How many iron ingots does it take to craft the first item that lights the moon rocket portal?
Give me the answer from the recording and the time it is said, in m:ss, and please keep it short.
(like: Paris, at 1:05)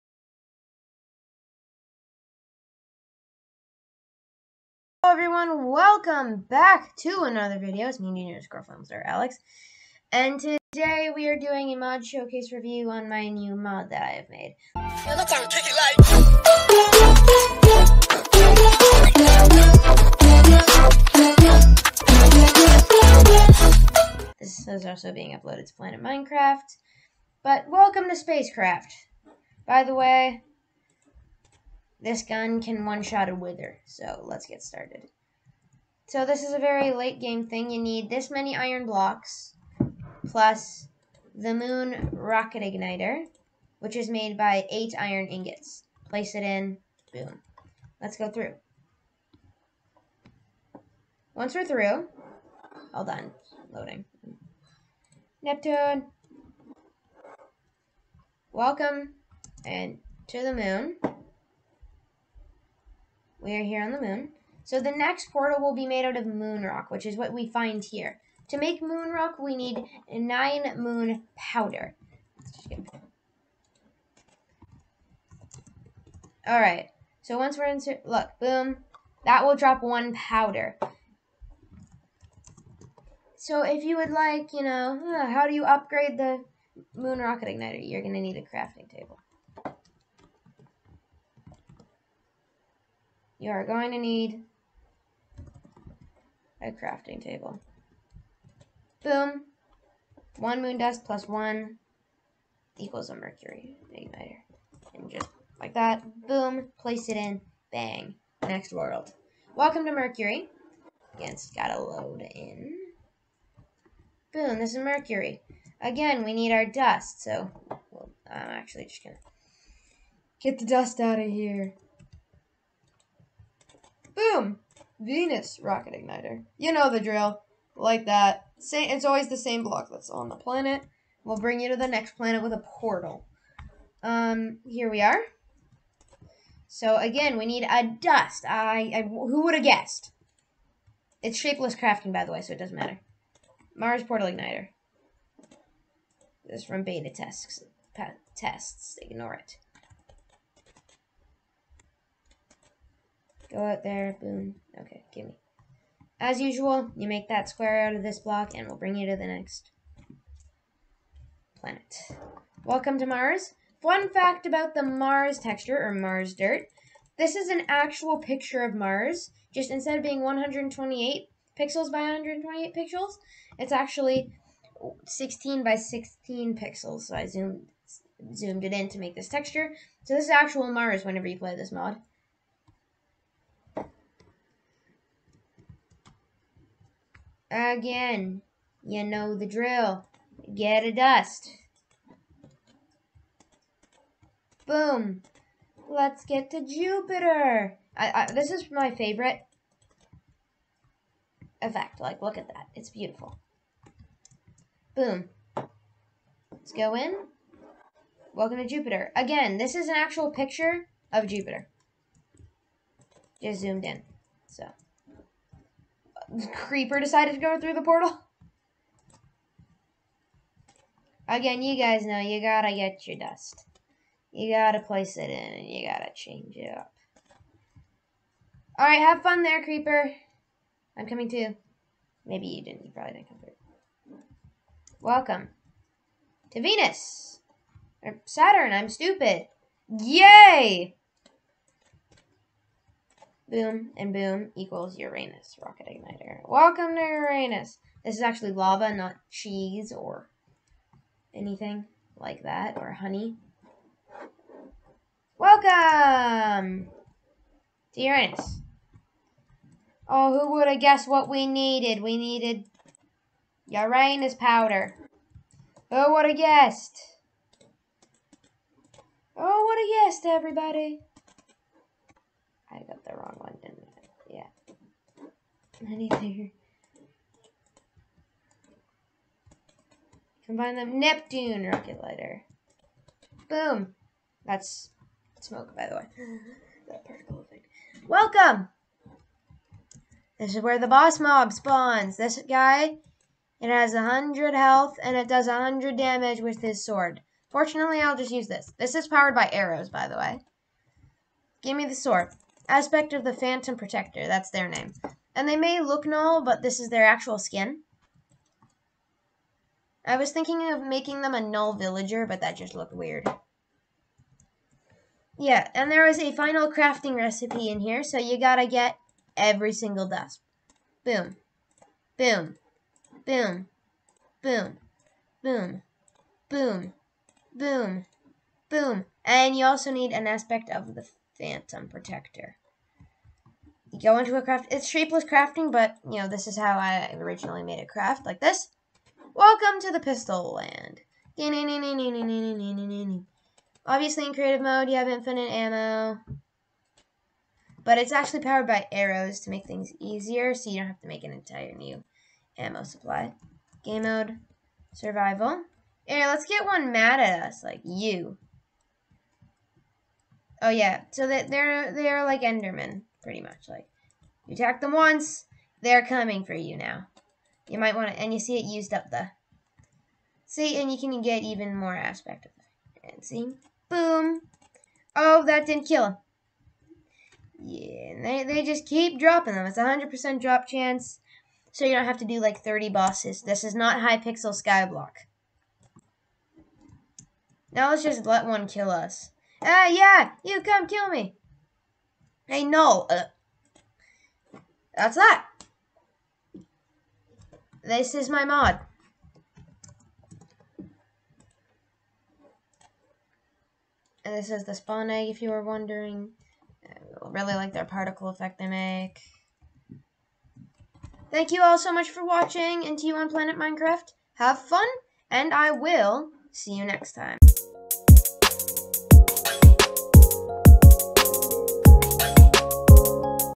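8, at 0:44.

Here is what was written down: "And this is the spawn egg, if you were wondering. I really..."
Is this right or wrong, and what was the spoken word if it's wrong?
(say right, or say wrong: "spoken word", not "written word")
right.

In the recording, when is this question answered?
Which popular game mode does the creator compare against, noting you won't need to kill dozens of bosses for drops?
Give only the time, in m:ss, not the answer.
6:23.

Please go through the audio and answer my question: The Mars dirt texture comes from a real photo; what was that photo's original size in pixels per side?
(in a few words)
128.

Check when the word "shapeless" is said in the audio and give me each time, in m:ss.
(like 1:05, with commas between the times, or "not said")
2:21, 5:34.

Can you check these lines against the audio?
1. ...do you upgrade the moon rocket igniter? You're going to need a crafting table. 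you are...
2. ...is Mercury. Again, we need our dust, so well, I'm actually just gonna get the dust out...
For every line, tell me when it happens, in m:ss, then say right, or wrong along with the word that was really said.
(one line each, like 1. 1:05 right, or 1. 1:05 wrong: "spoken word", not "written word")
1. 1:25 right
2. 1:54 right.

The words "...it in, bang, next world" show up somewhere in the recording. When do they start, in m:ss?
1:47.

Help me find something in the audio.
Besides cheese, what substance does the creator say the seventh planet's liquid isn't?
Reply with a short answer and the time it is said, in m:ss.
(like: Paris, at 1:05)
Honey, at 4:12.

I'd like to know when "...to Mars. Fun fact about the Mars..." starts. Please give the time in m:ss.
2:42.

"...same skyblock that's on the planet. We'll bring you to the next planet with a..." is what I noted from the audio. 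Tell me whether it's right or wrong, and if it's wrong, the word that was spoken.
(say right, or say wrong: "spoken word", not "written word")
wrong: "block", not "skyblock".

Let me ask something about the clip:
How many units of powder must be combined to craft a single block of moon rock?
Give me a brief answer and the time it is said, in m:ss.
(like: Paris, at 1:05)
9, at 1:10.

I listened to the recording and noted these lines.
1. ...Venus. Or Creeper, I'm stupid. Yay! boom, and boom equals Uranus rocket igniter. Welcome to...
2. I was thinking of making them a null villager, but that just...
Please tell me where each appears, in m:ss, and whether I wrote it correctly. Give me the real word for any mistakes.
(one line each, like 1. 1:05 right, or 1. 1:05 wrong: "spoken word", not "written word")
1. 3:56 wrong: "Saturn", not "Creeper"
2. 5:10 right.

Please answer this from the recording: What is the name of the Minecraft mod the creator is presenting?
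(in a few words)
Spacecraft.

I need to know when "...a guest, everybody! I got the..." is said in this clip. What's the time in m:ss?
4:29.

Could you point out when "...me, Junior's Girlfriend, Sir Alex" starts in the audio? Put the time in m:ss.
0:07.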